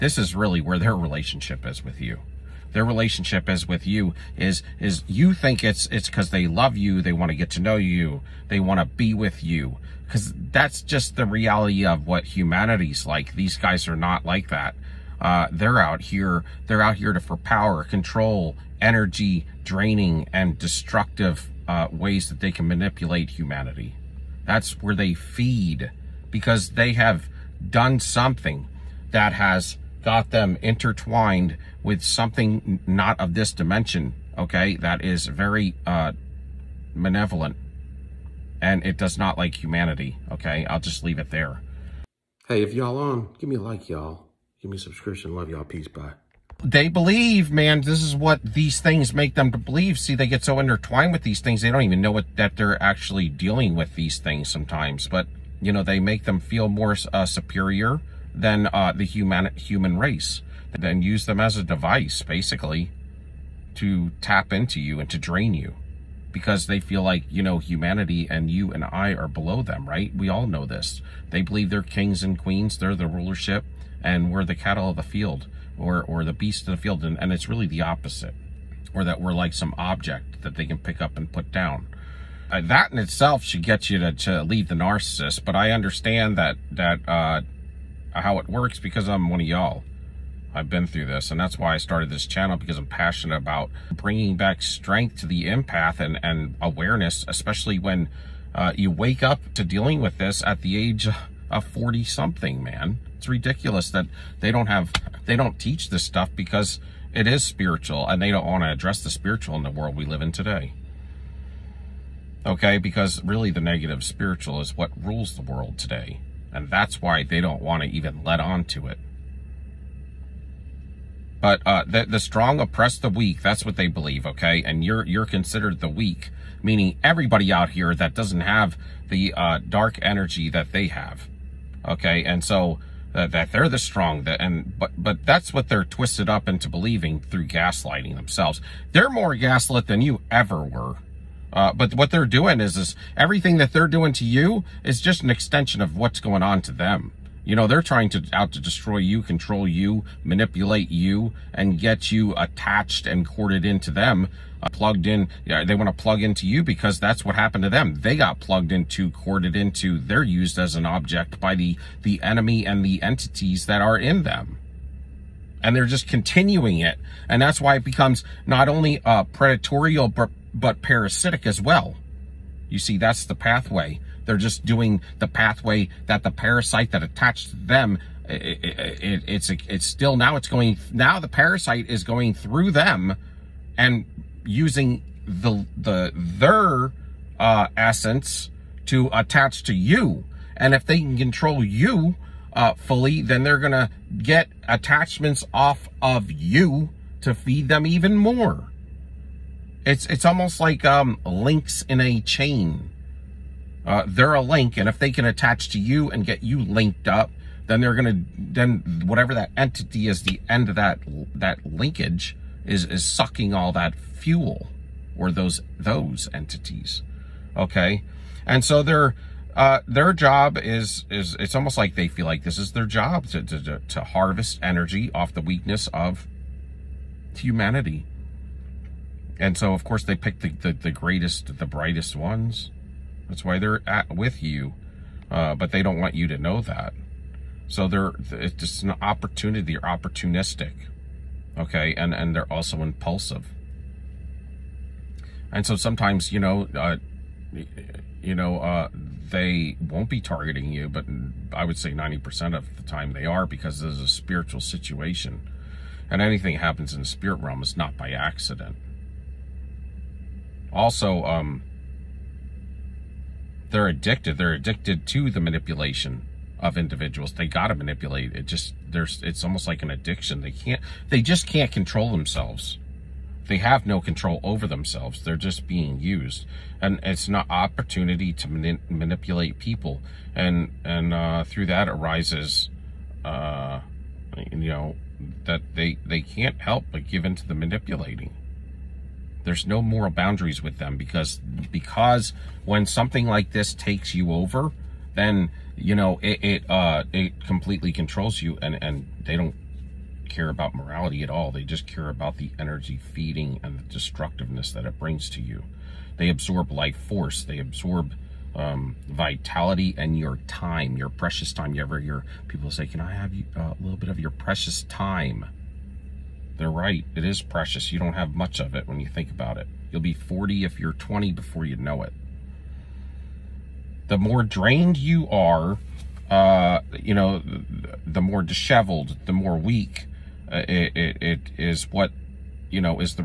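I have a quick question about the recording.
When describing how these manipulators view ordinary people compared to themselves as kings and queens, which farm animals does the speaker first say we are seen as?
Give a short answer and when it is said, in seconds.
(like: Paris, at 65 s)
cattle of the field, at 74 s.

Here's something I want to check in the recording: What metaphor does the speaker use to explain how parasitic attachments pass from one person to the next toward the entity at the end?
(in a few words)
links in a chain.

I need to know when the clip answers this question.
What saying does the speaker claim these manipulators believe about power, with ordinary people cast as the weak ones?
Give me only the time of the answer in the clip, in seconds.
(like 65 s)
122 s.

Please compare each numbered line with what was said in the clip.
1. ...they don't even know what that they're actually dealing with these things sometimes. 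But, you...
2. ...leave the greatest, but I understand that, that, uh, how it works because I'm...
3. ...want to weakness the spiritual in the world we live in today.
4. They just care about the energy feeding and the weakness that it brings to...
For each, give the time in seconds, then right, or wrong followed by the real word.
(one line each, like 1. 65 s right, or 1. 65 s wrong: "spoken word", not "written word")
1. 51 s right
2. 84 s wrong: "narcissist", not "greatest"
3. 108 s wrong: "address", not "weakness"
4. 301 s wrong: "destructiveness", not "weakness".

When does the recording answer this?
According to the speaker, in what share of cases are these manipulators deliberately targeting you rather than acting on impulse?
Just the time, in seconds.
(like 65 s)
251 s.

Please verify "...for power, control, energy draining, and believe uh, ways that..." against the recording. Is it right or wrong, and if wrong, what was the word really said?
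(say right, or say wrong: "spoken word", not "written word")
wrong: "destructive", not "believe".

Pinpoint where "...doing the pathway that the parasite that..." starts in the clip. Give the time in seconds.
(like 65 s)
174 s.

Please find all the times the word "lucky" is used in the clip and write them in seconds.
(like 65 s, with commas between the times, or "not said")
not said.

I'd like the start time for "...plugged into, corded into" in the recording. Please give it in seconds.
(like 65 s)
158 s.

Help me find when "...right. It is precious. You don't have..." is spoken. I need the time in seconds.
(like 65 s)
316 s.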